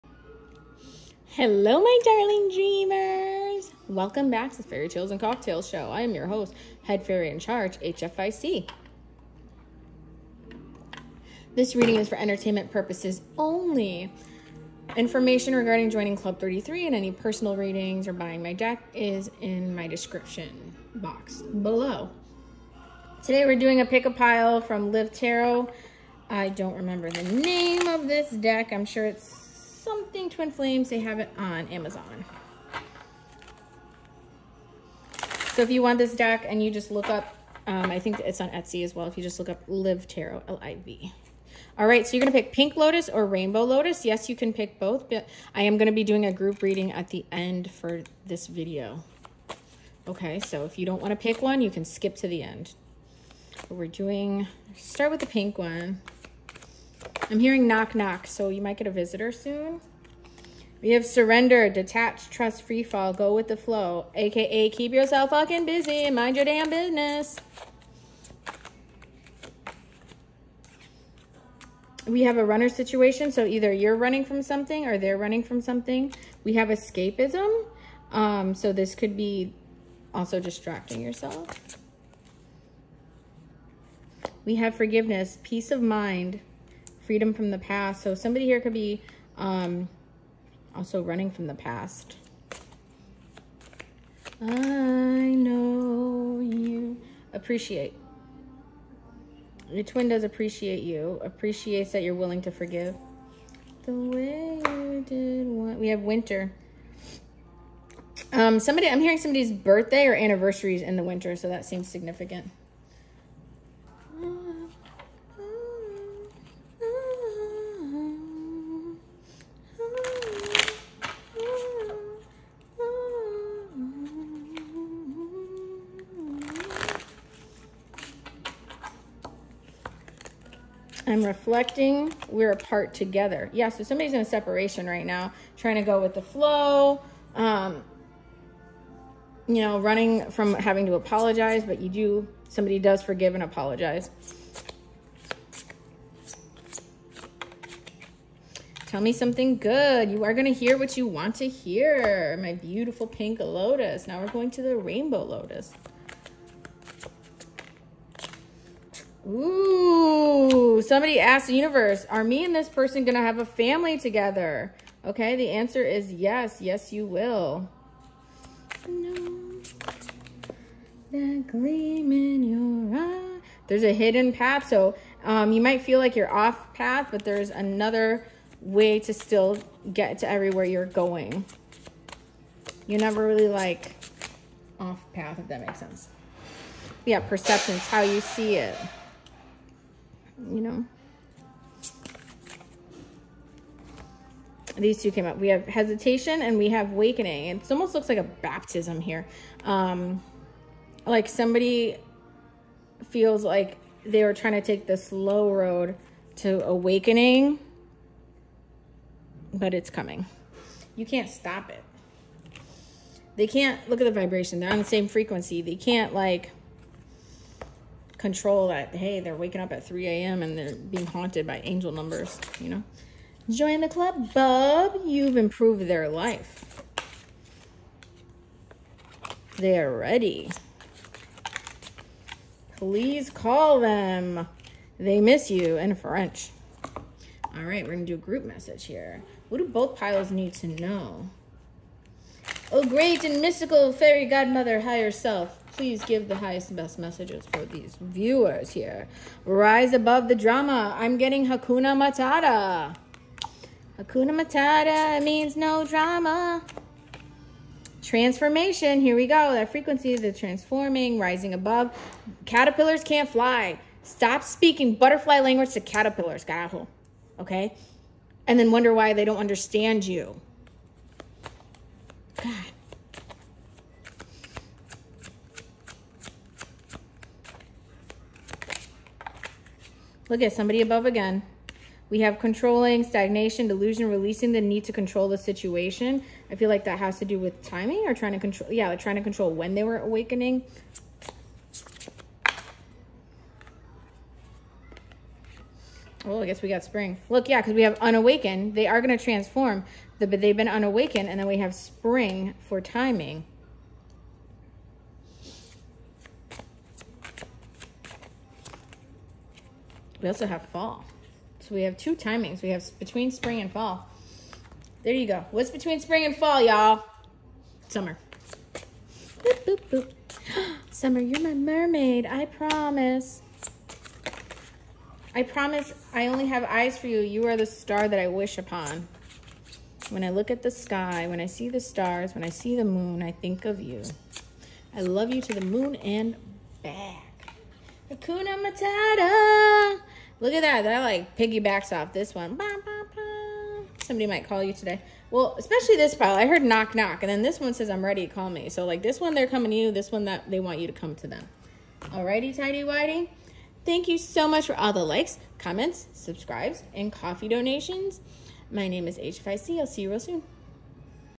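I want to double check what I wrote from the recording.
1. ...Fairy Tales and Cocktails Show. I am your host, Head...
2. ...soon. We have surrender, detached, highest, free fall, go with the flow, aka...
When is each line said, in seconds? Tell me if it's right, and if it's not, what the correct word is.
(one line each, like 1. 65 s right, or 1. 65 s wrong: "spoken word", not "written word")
1. 4 s right
2. 59 s wrong: "trust", not "highest".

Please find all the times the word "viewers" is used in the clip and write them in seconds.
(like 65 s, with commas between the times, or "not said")
247 s.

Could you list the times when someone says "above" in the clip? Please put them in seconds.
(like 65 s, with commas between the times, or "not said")
249 s, 261 s, 280 s.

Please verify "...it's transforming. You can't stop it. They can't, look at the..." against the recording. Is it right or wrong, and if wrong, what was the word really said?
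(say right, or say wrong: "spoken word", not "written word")
wrong: "coming", not "transforming".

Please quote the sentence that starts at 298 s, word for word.
They are going to transform, the, but they've been unawakened, and then we have spring for timing.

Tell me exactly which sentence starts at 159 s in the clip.
Ooh somebody asked the universe, are me and this person going to have a family together?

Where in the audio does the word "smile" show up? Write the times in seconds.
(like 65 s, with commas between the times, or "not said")
not said.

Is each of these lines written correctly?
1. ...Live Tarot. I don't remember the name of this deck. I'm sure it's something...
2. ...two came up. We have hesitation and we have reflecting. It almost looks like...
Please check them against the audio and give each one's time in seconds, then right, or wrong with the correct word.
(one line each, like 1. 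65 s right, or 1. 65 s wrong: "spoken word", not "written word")
1. 24 s right
2. 195 s wrong: "awakening", not "reflecting".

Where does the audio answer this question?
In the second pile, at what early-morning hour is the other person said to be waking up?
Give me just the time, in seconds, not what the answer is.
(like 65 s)
219 s.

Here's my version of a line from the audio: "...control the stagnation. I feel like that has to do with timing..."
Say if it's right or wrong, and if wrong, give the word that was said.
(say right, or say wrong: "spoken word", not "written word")
wrong: "situation", not "stagnation".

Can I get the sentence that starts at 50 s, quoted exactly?
Okay, so if you don't wanna pick one, you can skip to the end.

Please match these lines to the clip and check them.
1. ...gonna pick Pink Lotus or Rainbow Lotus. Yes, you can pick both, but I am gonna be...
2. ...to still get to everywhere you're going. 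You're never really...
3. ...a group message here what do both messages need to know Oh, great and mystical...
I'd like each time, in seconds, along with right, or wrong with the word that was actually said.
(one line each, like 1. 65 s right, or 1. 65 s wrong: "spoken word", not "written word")
1. 42 s right
2. 179 s right
3. 238 s wrong: "piles", not "messages".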